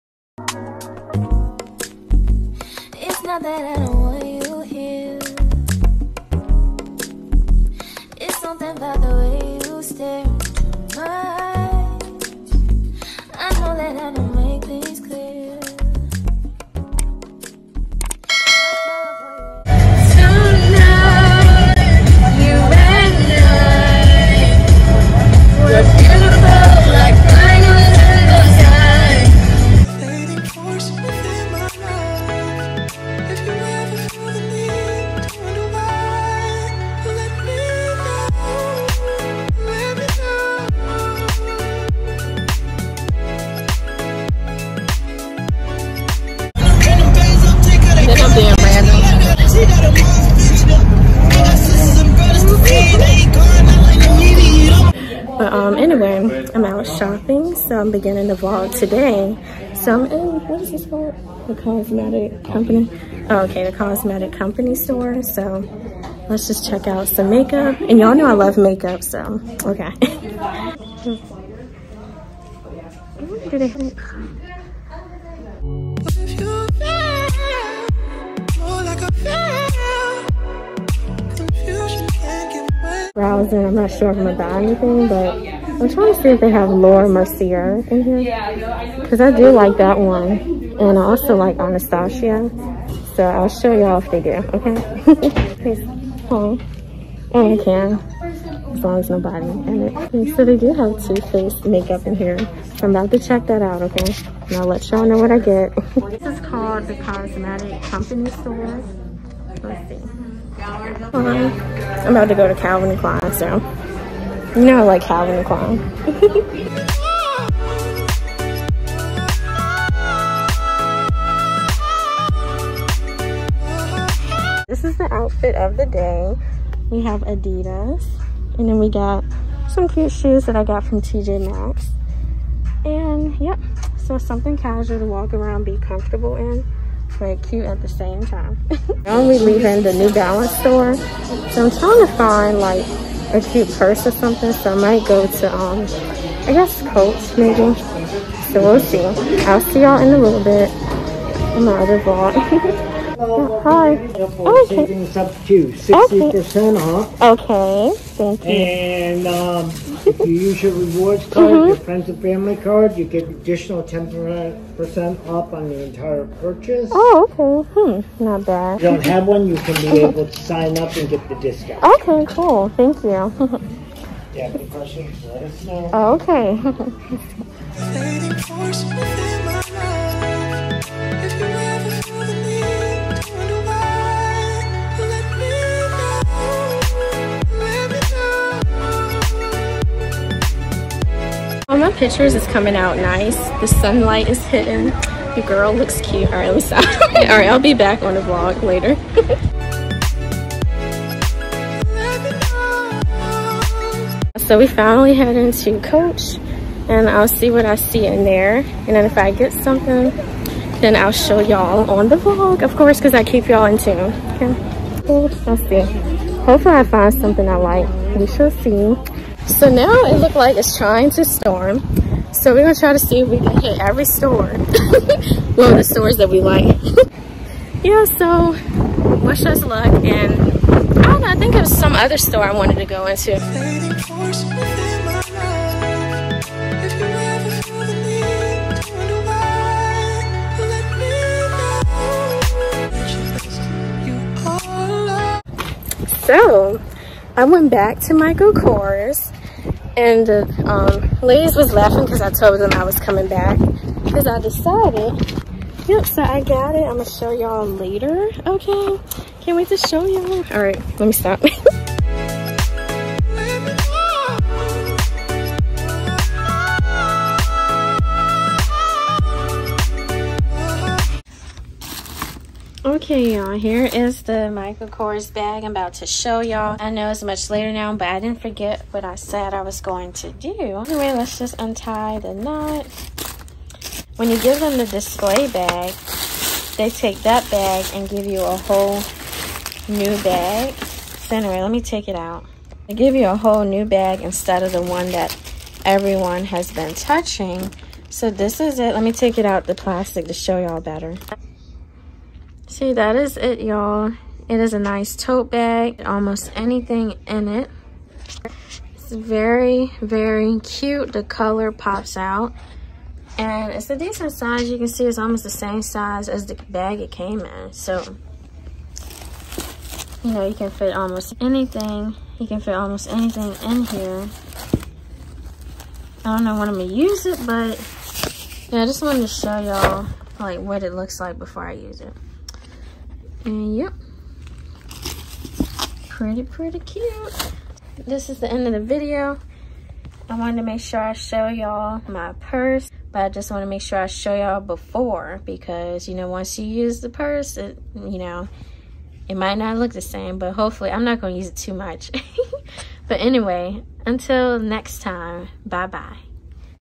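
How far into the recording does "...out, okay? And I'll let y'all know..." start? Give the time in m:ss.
1:43.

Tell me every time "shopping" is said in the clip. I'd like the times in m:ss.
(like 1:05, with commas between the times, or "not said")
0:56.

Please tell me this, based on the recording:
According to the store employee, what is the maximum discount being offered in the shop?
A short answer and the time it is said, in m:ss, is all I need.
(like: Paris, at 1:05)
60%, at 2:35.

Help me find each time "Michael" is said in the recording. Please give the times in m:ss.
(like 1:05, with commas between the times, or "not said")
4:08, 4:34.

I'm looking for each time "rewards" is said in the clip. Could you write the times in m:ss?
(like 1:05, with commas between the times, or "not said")
2:40.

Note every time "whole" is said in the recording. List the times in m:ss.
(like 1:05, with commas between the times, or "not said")
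4:48, 4:53.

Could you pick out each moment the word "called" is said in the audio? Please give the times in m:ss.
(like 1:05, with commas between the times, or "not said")
1:00, 1:46.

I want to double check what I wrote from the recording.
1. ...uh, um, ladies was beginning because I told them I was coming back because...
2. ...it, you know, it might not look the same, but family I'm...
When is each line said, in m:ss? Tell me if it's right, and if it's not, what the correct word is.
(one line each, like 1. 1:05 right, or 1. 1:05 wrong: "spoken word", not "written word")
1. 4:10 wrong: "laughing", not "beginning"
2. 5:47 wrong: "hopefully", not "family".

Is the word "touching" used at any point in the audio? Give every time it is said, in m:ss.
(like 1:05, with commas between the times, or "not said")
4:56.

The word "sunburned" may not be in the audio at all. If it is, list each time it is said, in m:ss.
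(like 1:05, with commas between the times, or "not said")
not said.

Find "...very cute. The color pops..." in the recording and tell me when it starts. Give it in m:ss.
5:10.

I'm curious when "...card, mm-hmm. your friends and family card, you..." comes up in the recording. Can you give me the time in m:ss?
2:41.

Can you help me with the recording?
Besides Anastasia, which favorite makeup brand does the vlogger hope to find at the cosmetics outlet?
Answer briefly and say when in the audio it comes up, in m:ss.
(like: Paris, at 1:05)
Laura Mercier, at 1:26.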